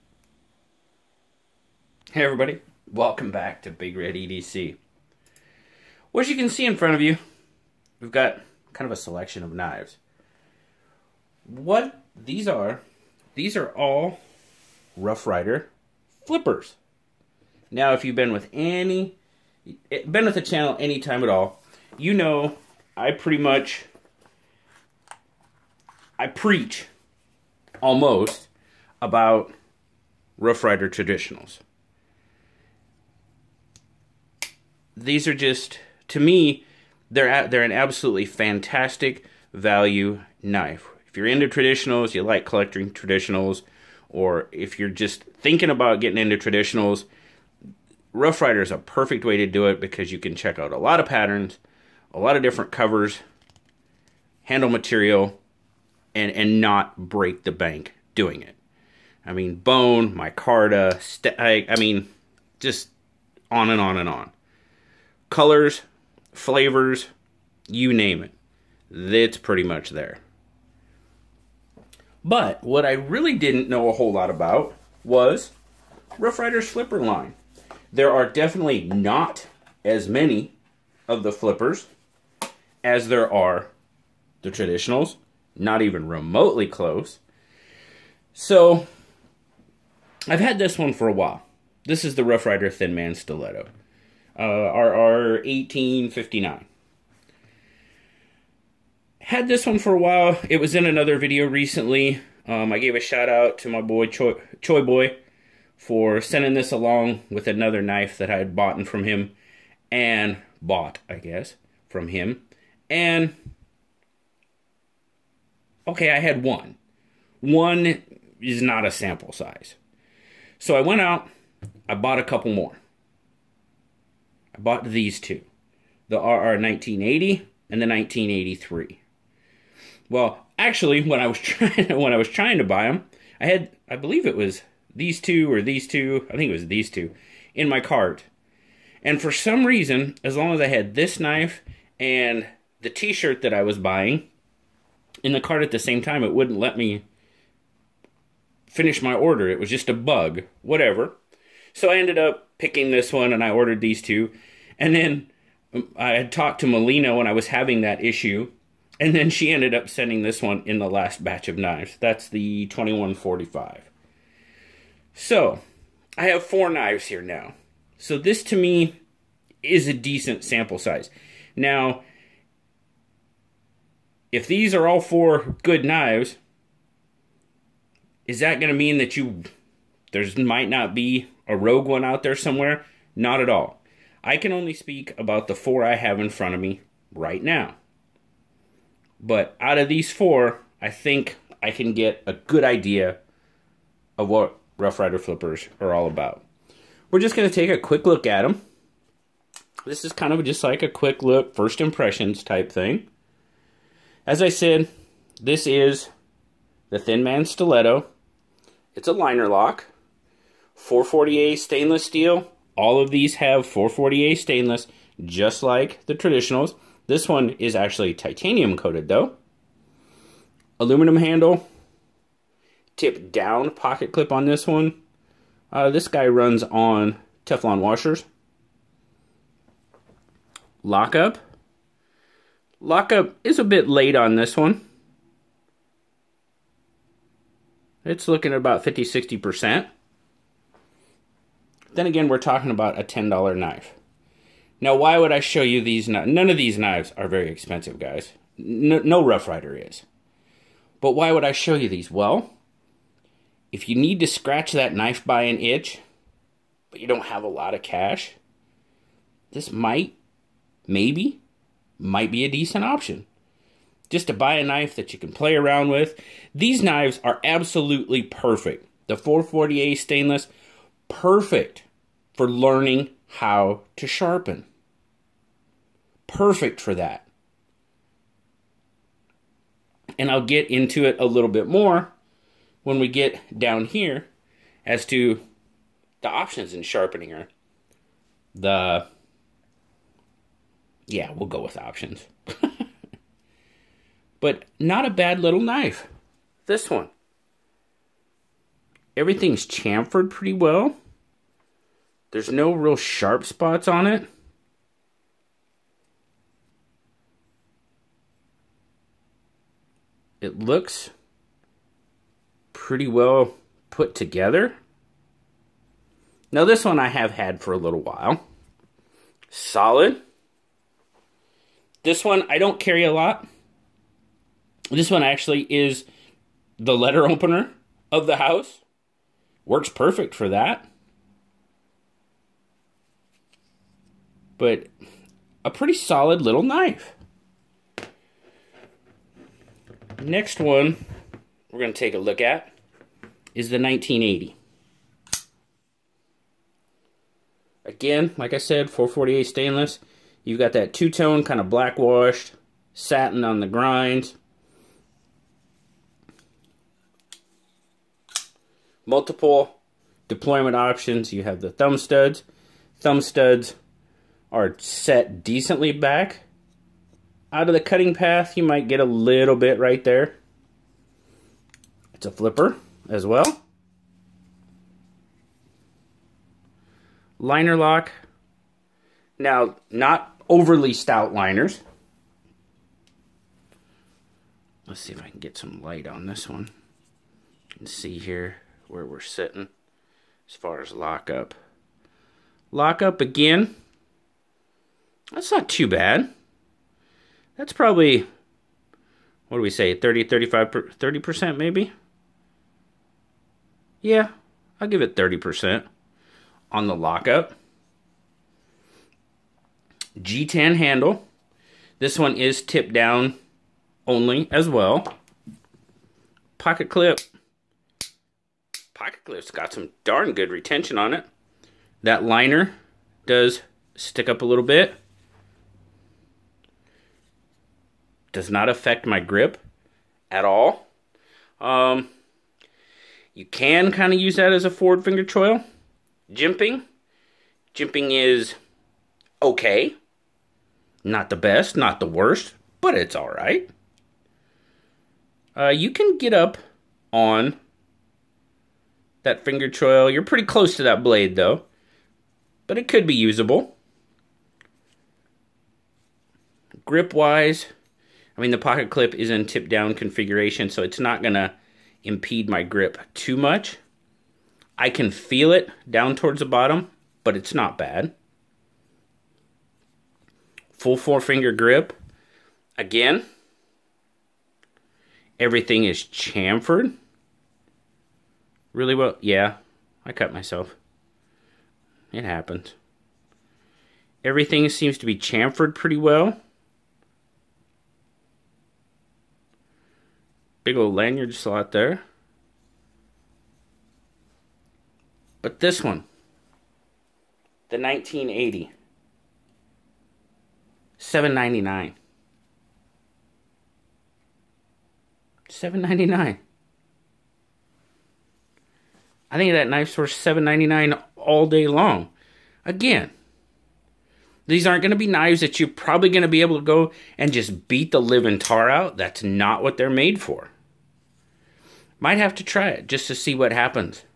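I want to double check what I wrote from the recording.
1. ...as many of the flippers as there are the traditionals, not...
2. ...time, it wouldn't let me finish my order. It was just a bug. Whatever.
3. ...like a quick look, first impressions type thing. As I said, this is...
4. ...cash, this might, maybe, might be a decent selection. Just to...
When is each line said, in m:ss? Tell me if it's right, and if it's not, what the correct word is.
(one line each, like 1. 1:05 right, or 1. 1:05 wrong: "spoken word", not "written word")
1. 1:19 right
2. 2:26 right
3. 3:20 right
4. 4:17 wrong: "option", not "selection".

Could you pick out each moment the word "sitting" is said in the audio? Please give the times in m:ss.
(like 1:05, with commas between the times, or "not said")
6:29.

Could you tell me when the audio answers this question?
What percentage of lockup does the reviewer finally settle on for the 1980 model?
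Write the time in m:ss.
6:45.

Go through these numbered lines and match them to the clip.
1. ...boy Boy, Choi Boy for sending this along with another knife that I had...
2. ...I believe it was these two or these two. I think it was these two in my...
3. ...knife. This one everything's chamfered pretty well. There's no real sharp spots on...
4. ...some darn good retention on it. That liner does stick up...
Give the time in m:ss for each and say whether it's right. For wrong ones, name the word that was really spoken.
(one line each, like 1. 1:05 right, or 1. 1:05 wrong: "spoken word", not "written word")
1. 1:43 wrong: "Choi", not "Boy"
2. 2:13 right
3. 4:55 right
4. 6:59 right.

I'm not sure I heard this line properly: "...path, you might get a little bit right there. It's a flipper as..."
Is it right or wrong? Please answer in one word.
right.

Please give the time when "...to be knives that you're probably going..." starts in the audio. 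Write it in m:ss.
8:34.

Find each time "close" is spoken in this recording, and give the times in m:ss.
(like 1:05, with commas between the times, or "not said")
1:26, 7:30.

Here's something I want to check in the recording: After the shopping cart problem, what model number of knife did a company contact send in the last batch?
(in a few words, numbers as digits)
2145.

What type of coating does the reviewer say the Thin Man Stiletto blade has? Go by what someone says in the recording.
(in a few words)
titanium coated.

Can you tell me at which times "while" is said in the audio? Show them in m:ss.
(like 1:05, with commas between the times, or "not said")
1:31, 1:39, 5:18.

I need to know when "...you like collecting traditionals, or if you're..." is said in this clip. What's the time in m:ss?
0:42.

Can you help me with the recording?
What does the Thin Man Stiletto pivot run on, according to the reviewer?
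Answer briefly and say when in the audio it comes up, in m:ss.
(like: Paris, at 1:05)
Teflon washers, at 3:47.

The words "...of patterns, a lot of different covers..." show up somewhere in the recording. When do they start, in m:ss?
0:50.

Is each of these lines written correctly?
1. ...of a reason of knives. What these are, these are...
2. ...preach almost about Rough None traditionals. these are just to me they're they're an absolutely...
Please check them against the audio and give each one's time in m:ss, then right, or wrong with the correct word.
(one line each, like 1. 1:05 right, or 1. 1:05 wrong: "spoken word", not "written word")
1. 0:08 wrong: "selection", not "reason"
2. 0:26 wrong: "Ryder", not "None".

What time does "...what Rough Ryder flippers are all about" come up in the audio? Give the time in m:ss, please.
3:14.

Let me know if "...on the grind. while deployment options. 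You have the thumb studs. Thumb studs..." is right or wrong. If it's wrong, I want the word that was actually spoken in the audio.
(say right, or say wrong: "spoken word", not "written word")
wrong: "multiple", not "while".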